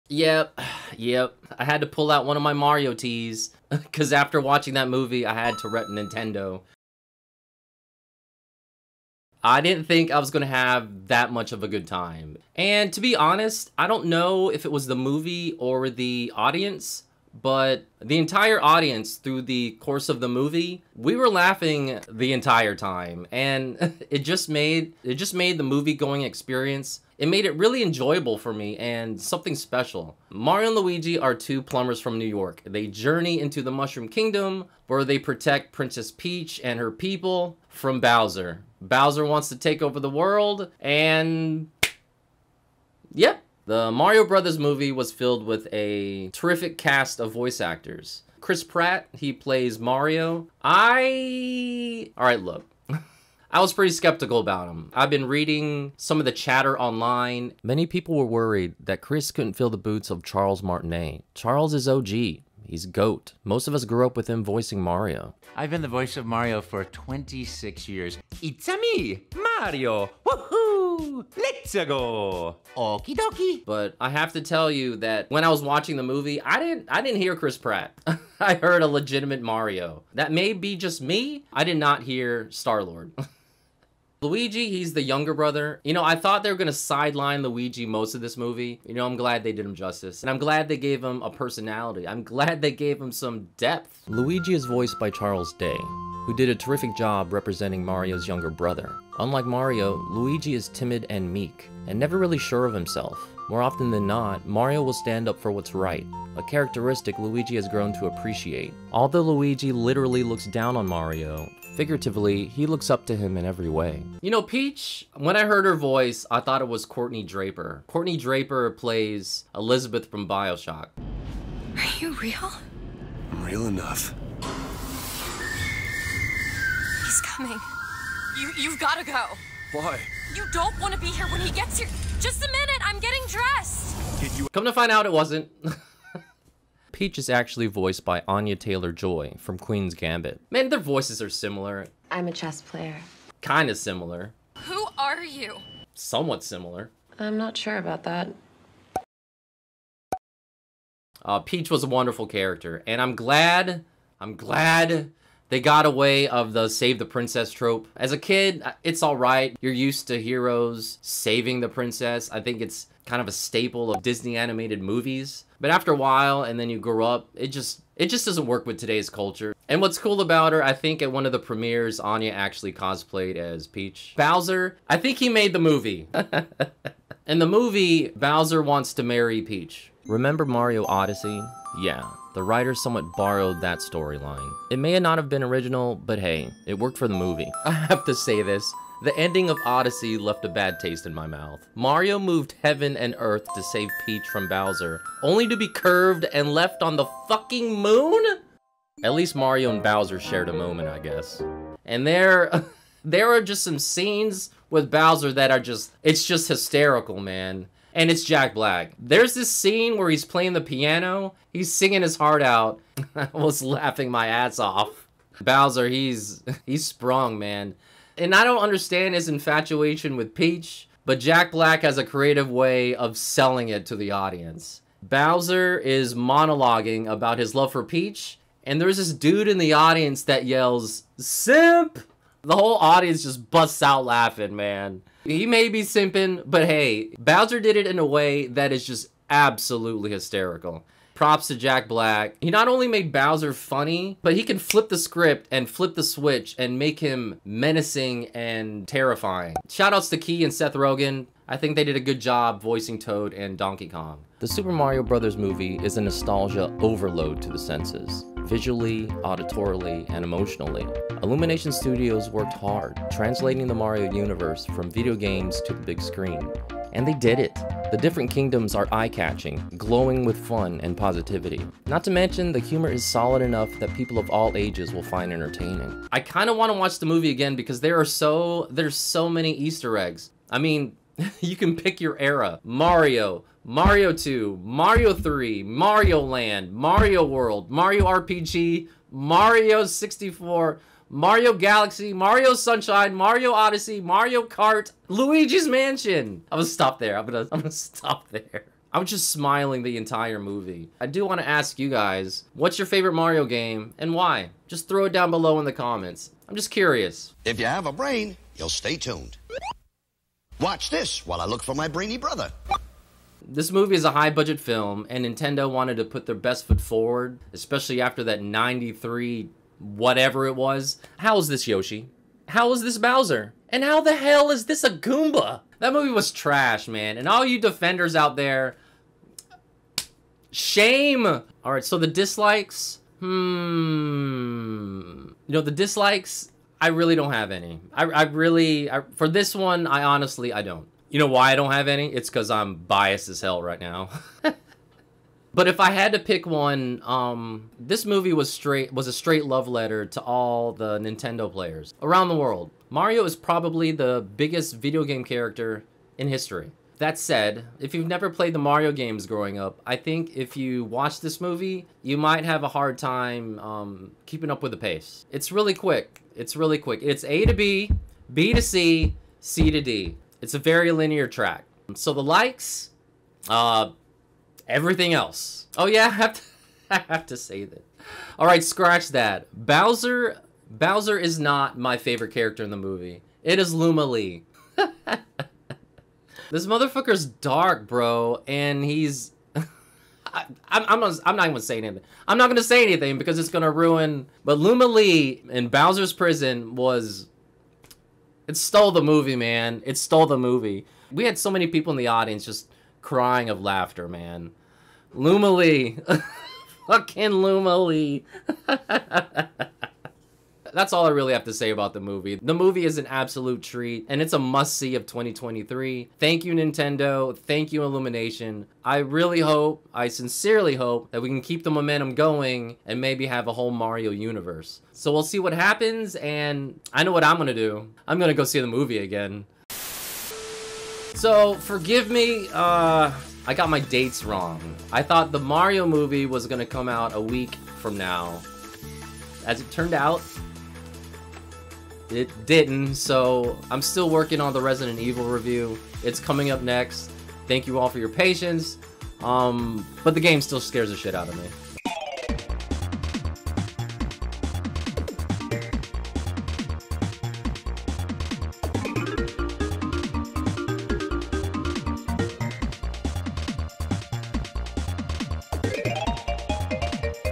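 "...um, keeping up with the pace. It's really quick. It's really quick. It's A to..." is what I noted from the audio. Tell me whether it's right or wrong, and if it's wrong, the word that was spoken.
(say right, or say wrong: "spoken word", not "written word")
right.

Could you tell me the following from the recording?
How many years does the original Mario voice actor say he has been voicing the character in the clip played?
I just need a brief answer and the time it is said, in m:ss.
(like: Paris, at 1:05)
26, at 1:06.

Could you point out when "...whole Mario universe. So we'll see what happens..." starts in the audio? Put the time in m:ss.
7:03.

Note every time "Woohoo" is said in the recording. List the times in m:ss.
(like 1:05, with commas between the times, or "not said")
1:10.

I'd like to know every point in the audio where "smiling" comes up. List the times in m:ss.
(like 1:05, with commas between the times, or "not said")
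4:59.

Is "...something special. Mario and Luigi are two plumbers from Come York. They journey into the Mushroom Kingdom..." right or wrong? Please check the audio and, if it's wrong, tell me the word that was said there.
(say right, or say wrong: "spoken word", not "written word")
wrong: "New", not "Come".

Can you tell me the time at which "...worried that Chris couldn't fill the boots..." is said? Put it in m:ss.
0:58.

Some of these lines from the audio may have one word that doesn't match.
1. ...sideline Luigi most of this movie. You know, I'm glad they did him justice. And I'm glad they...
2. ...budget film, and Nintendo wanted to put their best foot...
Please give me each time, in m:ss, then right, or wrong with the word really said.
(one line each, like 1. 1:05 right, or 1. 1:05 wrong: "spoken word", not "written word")
1. 1:26 right
2. 5:14 right.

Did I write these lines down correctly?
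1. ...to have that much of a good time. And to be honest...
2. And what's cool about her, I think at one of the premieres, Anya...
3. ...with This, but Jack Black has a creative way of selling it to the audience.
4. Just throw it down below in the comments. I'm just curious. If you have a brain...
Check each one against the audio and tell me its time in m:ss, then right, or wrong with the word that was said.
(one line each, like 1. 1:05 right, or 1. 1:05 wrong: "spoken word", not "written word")
1. 0:10 right
2. 2:49 right
3. 3:40 wrong: "Peach", not "This"
4. 5:04 right.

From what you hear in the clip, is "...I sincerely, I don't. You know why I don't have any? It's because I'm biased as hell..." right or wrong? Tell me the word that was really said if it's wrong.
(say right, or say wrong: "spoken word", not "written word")
wrong: "honestly", not "sincerely".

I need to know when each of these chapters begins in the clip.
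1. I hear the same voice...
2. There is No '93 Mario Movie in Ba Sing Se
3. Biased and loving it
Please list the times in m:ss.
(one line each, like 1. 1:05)
1. 1:53
2. 4:13
3. 5:30.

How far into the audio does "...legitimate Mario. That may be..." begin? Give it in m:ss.
1:18.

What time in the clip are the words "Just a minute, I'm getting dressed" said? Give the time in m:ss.
2:12.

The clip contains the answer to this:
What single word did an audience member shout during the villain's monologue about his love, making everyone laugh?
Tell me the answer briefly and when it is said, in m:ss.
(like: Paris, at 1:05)
Simp, at 3:51.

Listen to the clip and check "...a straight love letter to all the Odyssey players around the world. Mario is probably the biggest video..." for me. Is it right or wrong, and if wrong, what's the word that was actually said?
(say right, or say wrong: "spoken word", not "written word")
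wrong: "Nintendo", not "Odyssey".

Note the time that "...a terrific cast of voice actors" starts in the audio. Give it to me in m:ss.
0:45.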